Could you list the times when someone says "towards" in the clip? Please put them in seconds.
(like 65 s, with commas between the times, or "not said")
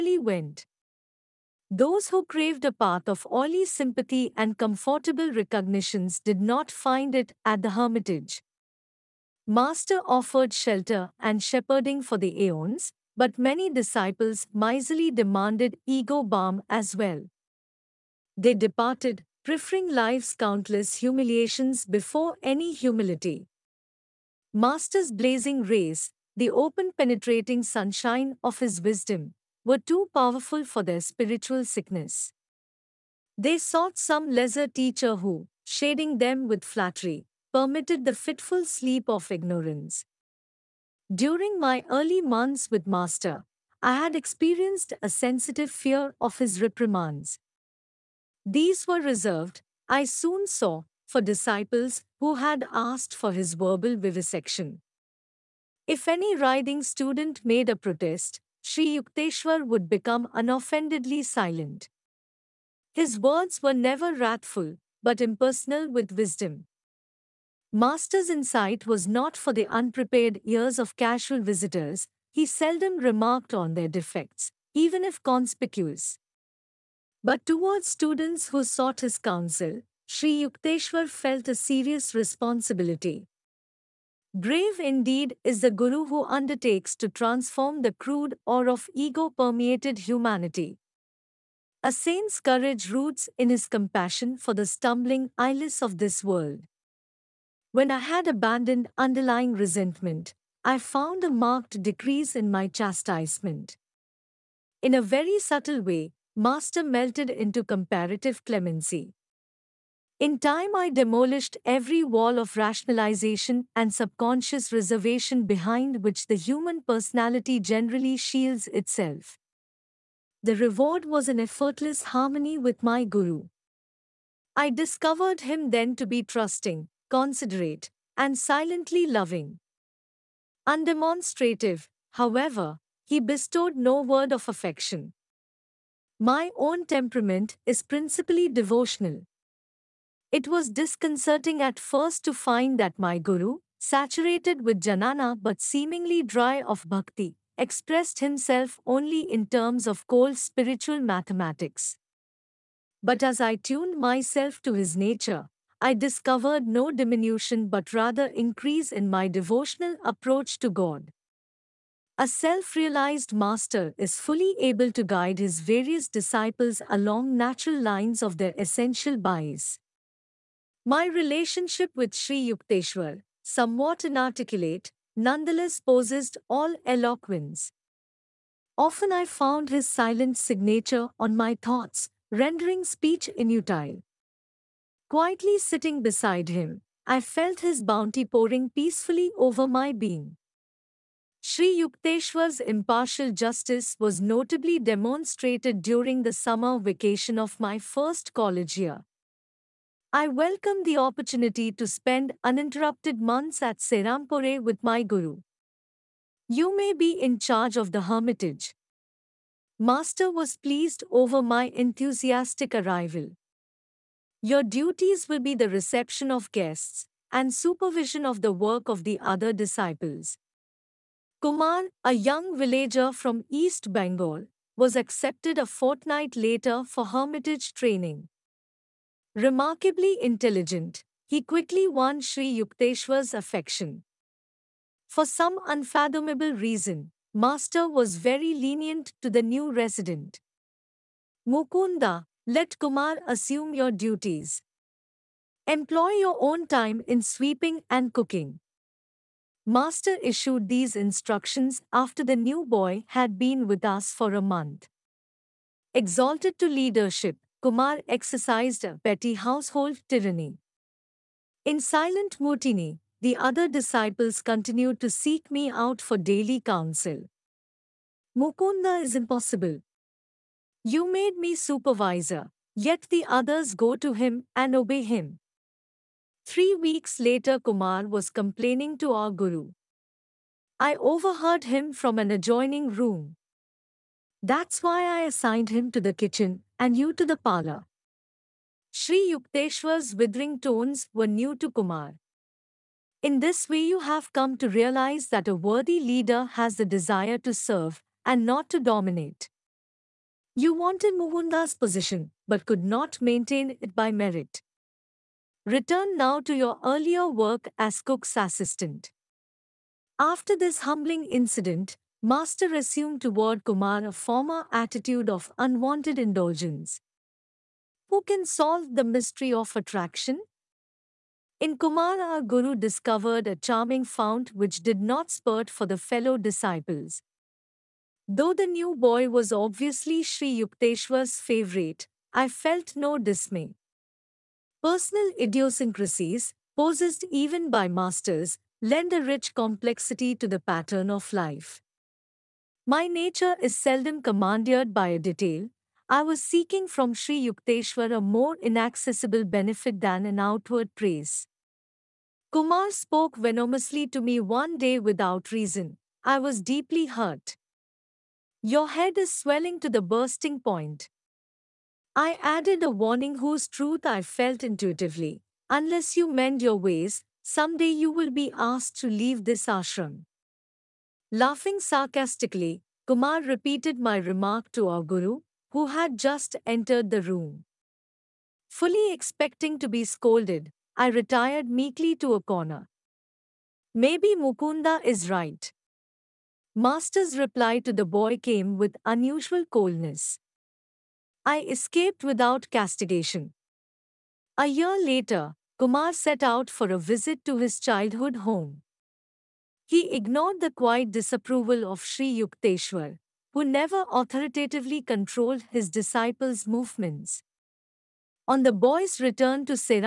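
77 s, 313 s.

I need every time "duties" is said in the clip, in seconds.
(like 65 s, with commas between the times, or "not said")
214 s, 243 s.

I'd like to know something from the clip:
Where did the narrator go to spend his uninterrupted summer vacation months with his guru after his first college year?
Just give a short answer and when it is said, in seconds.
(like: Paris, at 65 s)
Serampore, at 203 s.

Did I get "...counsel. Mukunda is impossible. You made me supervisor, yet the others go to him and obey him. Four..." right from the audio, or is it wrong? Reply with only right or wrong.
wrong.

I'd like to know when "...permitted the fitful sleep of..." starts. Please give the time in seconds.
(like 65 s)
37 s.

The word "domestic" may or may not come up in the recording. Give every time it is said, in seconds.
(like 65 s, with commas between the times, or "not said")
not said.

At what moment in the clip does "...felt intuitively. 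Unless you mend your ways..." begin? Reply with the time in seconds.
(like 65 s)
364 s.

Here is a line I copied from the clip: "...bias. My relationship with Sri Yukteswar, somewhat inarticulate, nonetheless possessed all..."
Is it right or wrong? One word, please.
right.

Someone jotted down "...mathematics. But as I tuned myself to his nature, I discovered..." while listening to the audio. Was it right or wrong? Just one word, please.
right.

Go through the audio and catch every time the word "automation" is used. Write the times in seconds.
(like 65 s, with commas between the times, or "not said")
not said.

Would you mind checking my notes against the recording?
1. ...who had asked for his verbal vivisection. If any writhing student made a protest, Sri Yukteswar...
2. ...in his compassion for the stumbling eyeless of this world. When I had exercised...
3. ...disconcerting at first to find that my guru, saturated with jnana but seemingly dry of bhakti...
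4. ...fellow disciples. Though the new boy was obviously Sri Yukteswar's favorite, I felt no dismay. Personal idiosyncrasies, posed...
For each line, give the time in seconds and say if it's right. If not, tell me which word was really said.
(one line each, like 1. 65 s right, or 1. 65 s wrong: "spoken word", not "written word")
1. 52 s right
2. 93 s wrong: "abandoned", not "exercised"
3. 140 s right
4. 325 s right.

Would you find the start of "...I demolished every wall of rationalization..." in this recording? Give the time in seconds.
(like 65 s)
110 s.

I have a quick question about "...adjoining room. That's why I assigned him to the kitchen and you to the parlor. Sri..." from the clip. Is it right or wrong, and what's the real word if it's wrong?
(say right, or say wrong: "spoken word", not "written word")
right.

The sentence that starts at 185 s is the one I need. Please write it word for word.
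Quietly sitting beside him, I felt his bounty pouring peacefully over my being.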